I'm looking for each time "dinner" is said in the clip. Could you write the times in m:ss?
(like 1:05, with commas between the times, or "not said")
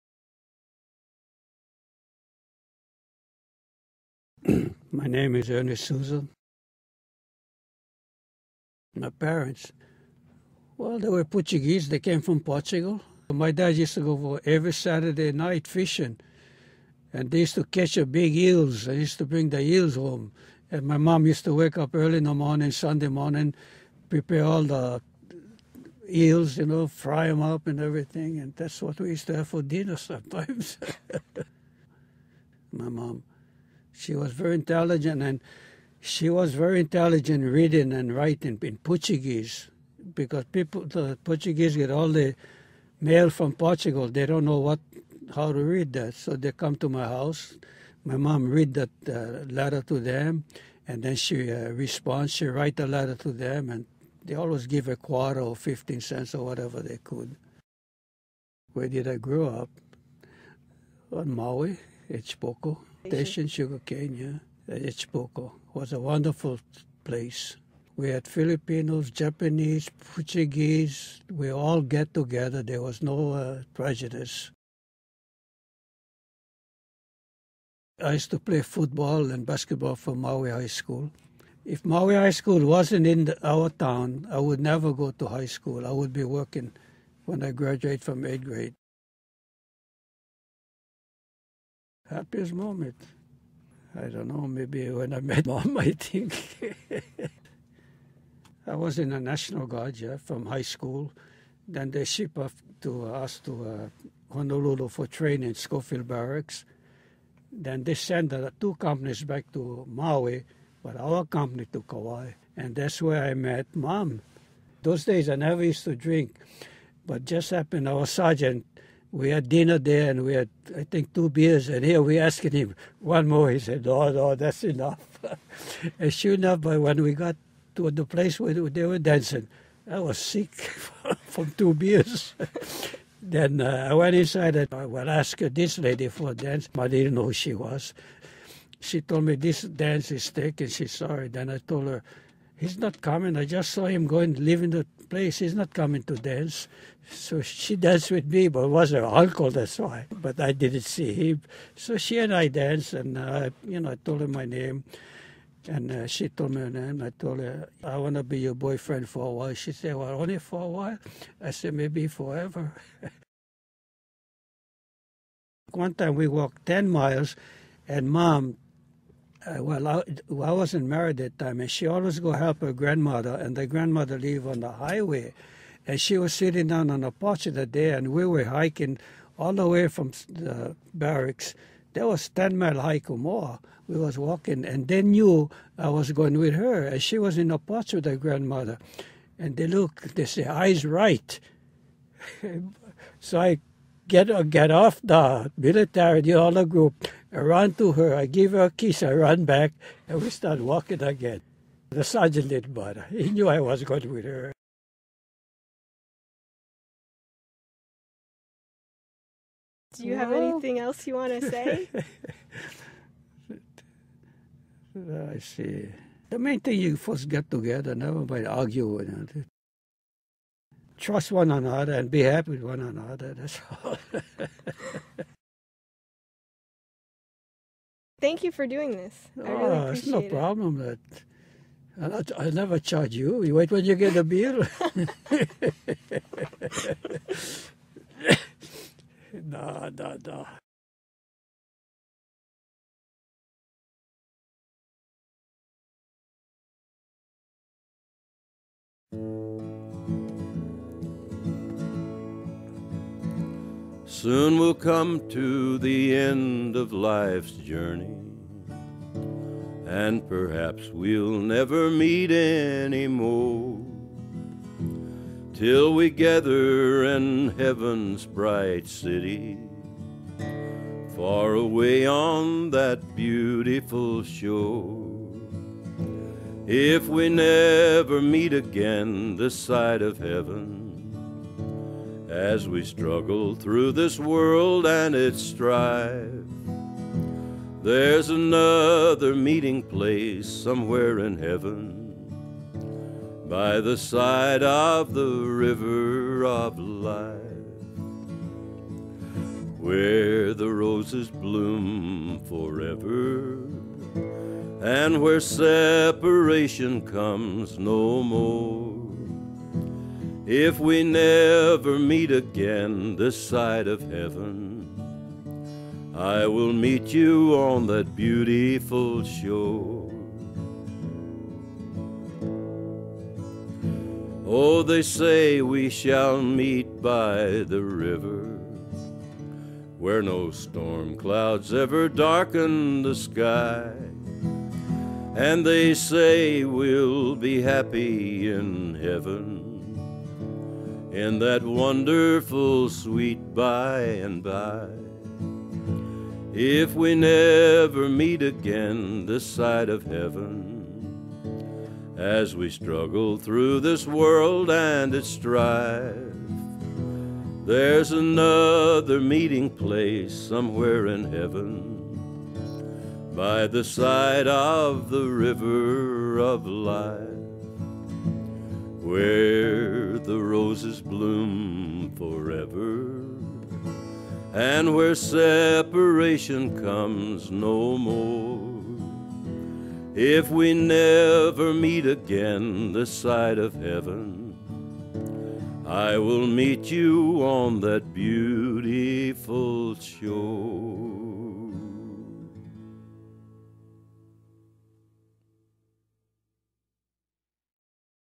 0:29, 1:59.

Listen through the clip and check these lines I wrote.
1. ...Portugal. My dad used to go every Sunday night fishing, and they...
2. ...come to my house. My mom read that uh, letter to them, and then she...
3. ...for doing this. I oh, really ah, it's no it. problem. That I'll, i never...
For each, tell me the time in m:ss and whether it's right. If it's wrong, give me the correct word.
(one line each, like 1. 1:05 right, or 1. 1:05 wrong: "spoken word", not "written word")
1. 0:12 wrong: "Saturday", not "Sunday"
2. 0:46 right
3. 3:48 right.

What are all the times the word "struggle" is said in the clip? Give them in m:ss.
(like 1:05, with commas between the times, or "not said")
4:42, 5:52.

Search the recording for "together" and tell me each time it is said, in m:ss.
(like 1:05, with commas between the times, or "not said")
1:12, 3:37.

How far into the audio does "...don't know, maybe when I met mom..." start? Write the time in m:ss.
1:34.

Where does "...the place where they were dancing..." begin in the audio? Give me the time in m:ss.
2:07.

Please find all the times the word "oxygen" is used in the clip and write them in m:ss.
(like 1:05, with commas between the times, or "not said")
not said.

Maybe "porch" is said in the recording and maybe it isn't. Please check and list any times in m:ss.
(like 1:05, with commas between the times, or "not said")
2:57, 3:07.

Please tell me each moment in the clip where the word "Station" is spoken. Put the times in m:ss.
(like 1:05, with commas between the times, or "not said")
1:03.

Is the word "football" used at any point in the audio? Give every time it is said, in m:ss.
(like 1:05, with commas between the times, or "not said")
1:18.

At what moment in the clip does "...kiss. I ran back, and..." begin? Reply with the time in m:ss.
3:18.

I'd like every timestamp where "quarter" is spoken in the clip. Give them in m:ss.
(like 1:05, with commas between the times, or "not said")
0:54.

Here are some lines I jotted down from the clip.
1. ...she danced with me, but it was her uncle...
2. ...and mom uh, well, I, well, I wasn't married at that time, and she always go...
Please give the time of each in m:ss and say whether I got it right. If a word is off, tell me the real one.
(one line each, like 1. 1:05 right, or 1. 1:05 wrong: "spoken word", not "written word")
1. 2:27 right
2. 2:47 right.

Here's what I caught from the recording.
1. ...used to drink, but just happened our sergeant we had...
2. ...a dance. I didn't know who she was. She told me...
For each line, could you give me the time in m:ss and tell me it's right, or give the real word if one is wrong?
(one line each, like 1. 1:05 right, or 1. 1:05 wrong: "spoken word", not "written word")
1. 1:55 right
2. 2:16 right.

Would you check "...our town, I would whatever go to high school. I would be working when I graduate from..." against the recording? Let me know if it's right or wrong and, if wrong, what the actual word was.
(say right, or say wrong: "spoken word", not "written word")
wrong: "never", not "whatever".